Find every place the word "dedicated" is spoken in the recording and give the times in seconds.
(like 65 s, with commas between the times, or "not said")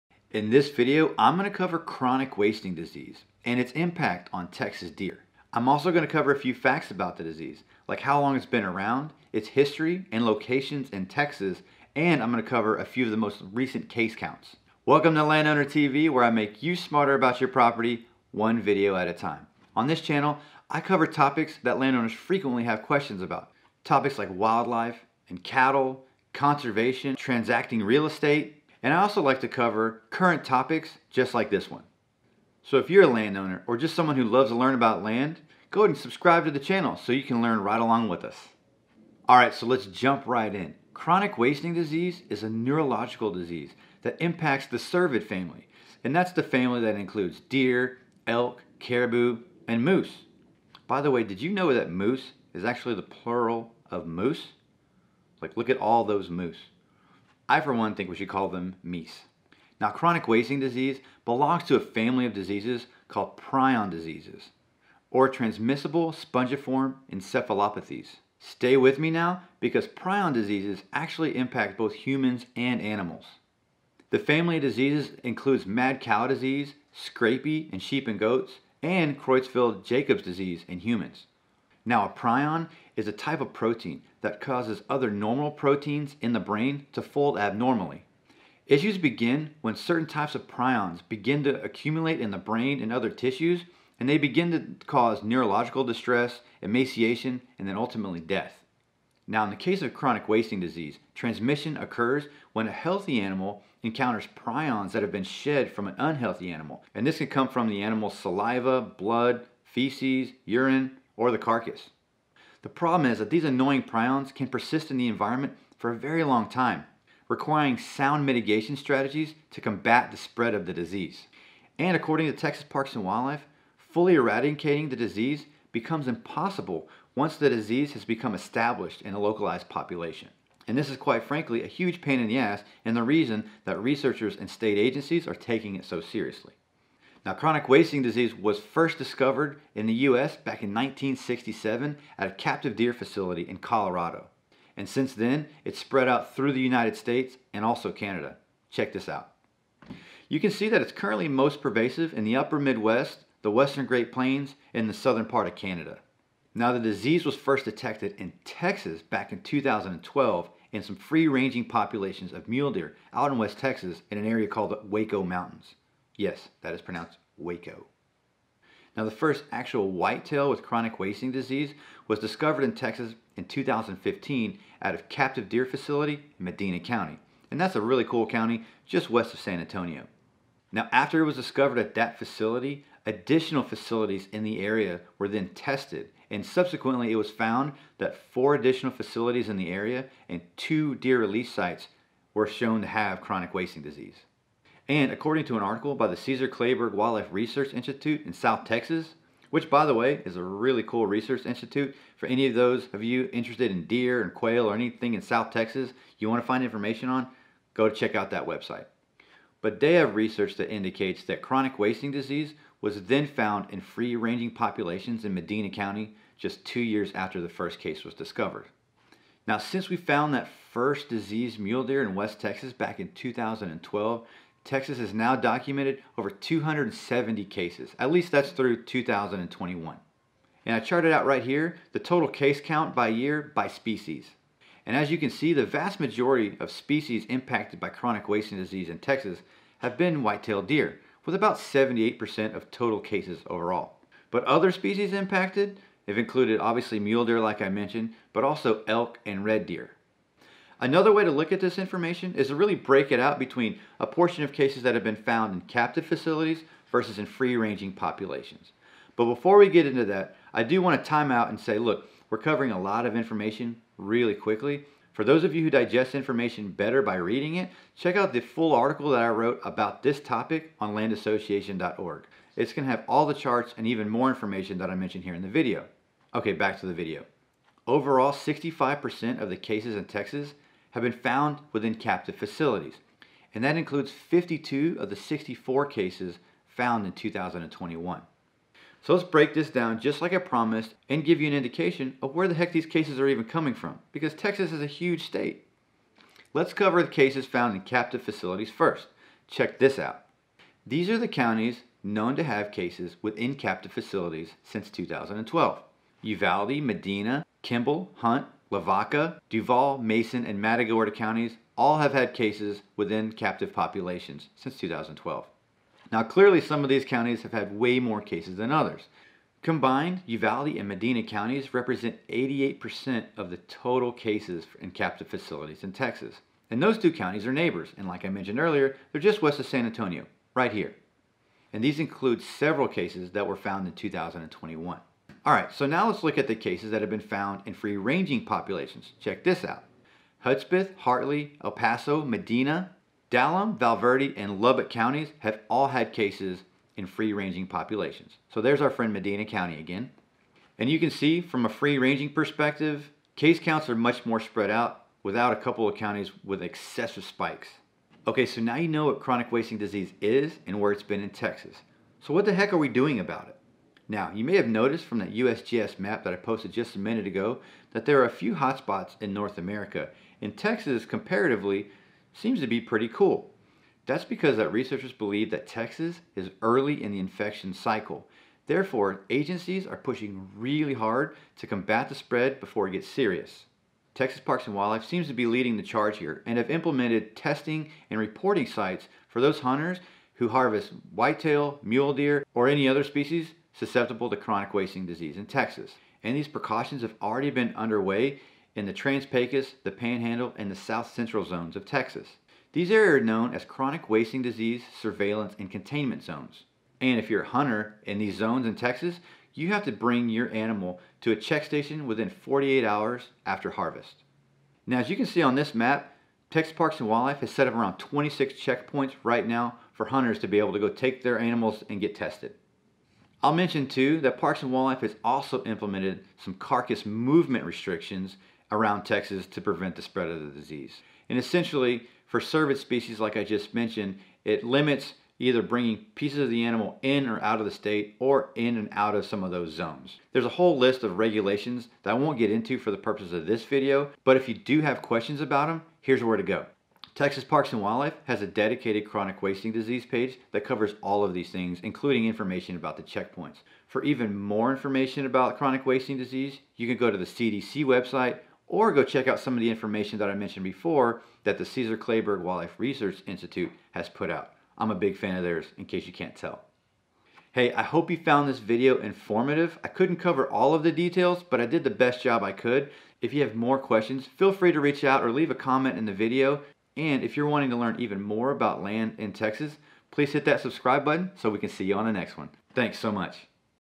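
448 s.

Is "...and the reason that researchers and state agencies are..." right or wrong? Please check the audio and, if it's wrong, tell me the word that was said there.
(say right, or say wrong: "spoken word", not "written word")
right.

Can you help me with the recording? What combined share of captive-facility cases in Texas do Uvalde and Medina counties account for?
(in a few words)
88%.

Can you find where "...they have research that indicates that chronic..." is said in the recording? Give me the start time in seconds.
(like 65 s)
209 s.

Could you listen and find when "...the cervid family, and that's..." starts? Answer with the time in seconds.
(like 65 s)
44 s.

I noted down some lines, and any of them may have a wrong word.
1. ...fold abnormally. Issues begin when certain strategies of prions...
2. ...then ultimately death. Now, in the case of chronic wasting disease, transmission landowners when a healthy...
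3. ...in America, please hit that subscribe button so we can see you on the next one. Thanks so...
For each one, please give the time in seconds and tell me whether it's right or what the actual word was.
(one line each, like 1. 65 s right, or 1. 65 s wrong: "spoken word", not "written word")
1. 87 s wrong: "types", not "strategies"
2. 97 s wrong: "occurs", not "landowners"
3. 479 s wrong: "Texas", not "America".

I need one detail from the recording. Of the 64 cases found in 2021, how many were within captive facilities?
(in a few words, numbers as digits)
52.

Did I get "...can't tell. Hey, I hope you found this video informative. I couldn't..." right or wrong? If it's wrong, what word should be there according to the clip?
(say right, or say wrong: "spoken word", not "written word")
right.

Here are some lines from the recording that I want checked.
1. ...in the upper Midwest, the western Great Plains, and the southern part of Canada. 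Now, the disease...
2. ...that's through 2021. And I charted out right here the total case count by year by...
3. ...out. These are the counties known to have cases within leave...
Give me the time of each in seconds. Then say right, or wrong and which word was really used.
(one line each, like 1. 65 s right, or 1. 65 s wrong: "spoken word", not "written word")
1. 152 s right
2. 228 s right
3. 299 s wrong: "captive", not "leave".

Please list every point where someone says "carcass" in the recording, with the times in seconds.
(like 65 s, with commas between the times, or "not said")
111 s, 426 s.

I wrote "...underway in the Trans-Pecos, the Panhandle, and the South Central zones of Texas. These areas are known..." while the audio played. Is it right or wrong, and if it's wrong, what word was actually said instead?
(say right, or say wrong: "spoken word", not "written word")
right.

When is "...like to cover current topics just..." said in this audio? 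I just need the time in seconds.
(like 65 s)
29 s.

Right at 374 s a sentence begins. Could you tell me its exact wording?
That's because that researchers believe that Texas is early in the infection cycle.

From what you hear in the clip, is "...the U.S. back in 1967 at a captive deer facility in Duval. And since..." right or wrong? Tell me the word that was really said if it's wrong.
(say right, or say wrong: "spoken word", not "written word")
wrong: "Colorado", not "Duval".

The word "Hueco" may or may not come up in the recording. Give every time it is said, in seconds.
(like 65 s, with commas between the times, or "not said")
164 s.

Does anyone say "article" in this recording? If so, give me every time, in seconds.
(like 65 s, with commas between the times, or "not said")
195 s, 268 s.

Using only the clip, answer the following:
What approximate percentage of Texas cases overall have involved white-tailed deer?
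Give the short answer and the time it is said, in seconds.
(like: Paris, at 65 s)
78%, at 241 s.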